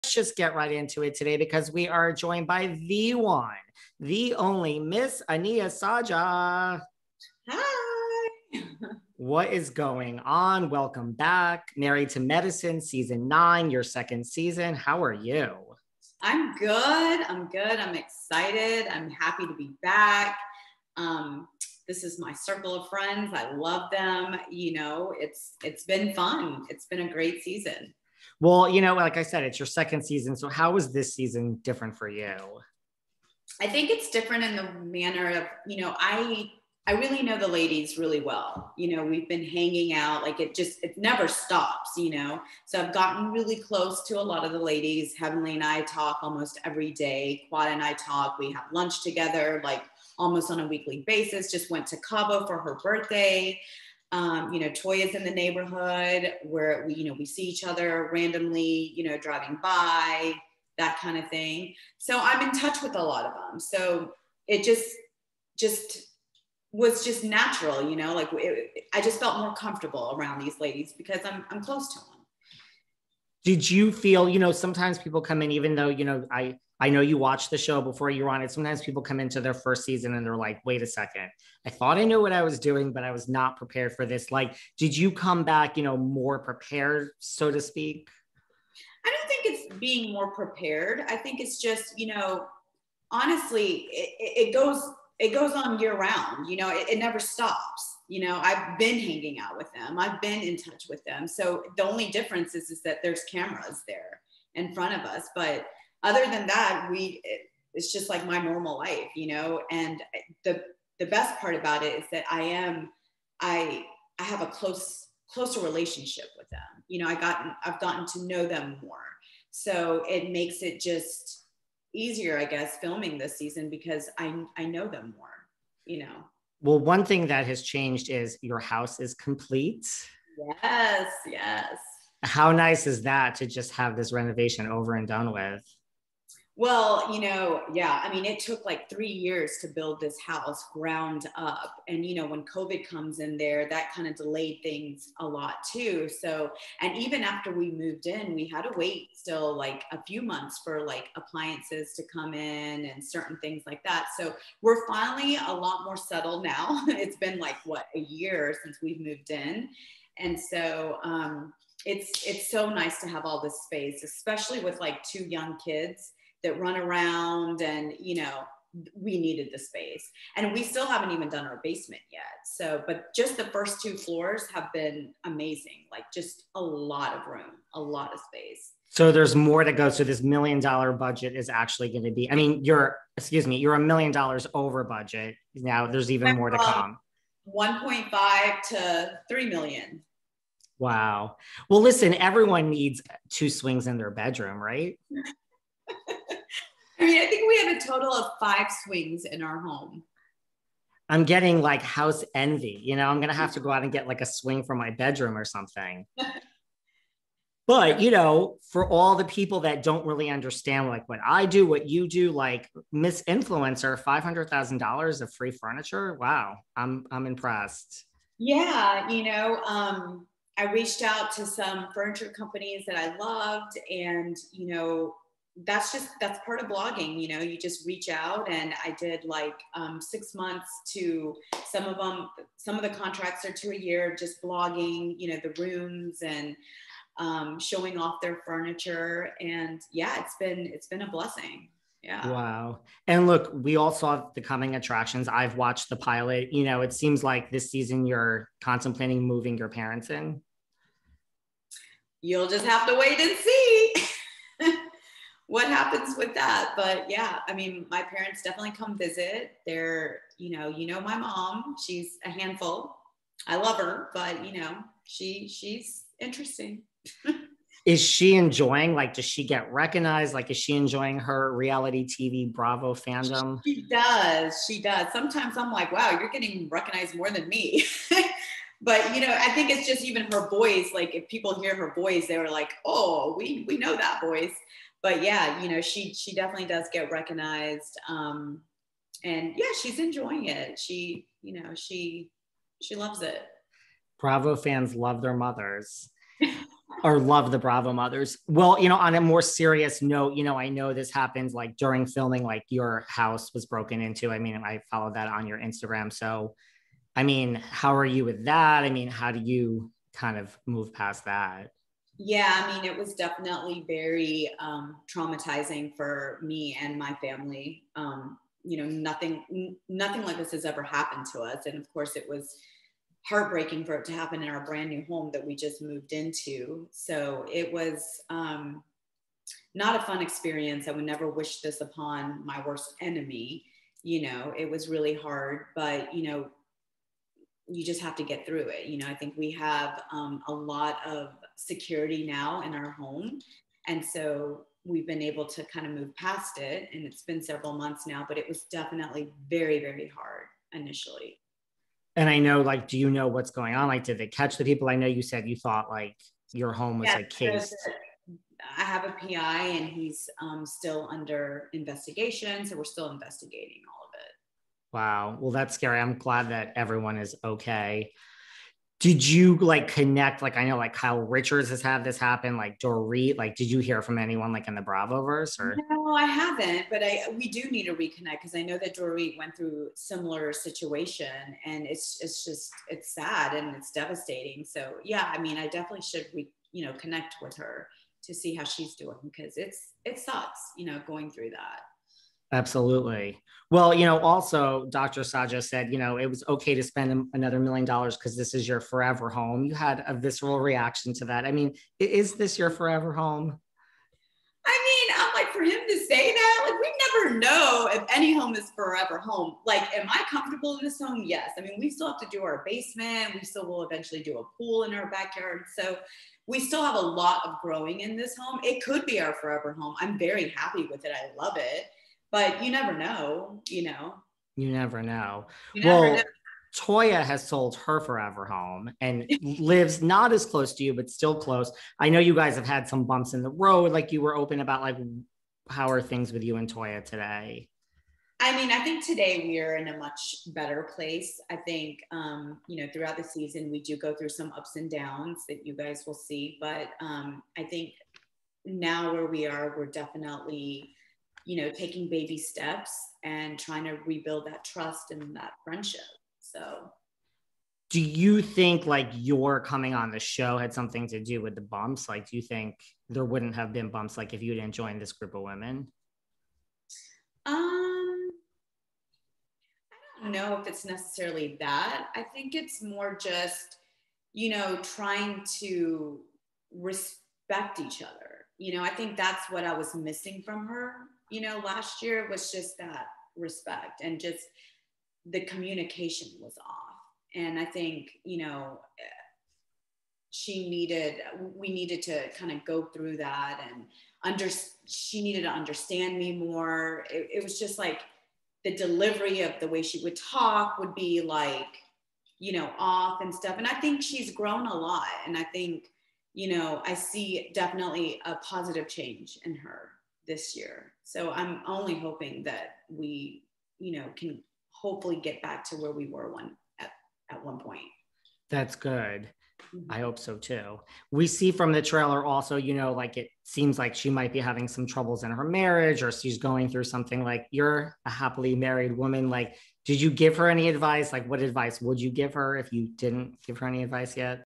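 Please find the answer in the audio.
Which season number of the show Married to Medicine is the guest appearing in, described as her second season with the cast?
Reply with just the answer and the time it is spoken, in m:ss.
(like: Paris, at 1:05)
9, at 0:12.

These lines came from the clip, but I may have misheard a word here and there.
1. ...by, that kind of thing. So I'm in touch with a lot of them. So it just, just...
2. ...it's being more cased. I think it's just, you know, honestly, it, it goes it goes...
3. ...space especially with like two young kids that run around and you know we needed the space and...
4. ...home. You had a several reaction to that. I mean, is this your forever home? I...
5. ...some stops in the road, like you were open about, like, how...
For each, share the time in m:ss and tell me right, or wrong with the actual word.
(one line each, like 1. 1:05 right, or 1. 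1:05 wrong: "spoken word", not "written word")
1. 0:59 right
2. 1:29 wrong: "prepared", not "cased"
3. 2:43 right
4. 6:39 wrong: "visceral", not "several"
5. 7:12 wrong: "bumps", not "stops".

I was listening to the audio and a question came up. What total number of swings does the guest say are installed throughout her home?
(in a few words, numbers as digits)
5.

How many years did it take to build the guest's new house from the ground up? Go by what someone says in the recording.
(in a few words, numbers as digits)
3.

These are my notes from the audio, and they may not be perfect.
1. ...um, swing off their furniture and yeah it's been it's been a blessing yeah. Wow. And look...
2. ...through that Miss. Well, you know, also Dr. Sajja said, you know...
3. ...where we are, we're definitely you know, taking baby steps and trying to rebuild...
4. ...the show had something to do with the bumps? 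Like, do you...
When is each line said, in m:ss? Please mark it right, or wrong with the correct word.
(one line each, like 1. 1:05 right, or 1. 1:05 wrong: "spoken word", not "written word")
1. 3:57 wrong: "showing", not "swing"
2. 6:31 wrong: "Absolutely", not "Miss"
3. 7:29 right
4. 7:40 right.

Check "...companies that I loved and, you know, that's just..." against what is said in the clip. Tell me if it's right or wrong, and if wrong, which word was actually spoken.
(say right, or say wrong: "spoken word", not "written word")
right.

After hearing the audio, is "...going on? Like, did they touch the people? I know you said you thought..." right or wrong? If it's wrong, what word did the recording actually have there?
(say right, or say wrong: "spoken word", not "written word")
wrong: "catch", not "touch".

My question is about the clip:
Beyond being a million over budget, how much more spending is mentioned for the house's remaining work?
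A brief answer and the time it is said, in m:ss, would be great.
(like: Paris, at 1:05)
1.5 to 3 million, at 3:07.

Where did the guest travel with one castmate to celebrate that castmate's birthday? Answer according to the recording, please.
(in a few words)
Cabo.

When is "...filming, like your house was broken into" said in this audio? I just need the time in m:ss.
5:02.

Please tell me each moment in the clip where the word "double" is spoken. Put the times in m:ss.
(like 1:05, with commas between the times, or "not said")
not said.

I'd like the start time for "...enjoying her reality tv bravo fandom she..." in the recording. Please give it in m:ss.
4:30.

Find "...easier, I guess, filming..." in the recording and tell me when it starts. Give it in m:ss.
2:01.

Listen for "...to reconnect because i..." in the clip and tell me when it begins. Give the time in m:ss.
6:17.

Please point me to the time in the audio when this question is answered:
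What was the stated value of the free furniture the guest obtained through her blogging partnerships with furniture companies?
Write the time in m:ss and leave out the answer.
3:34.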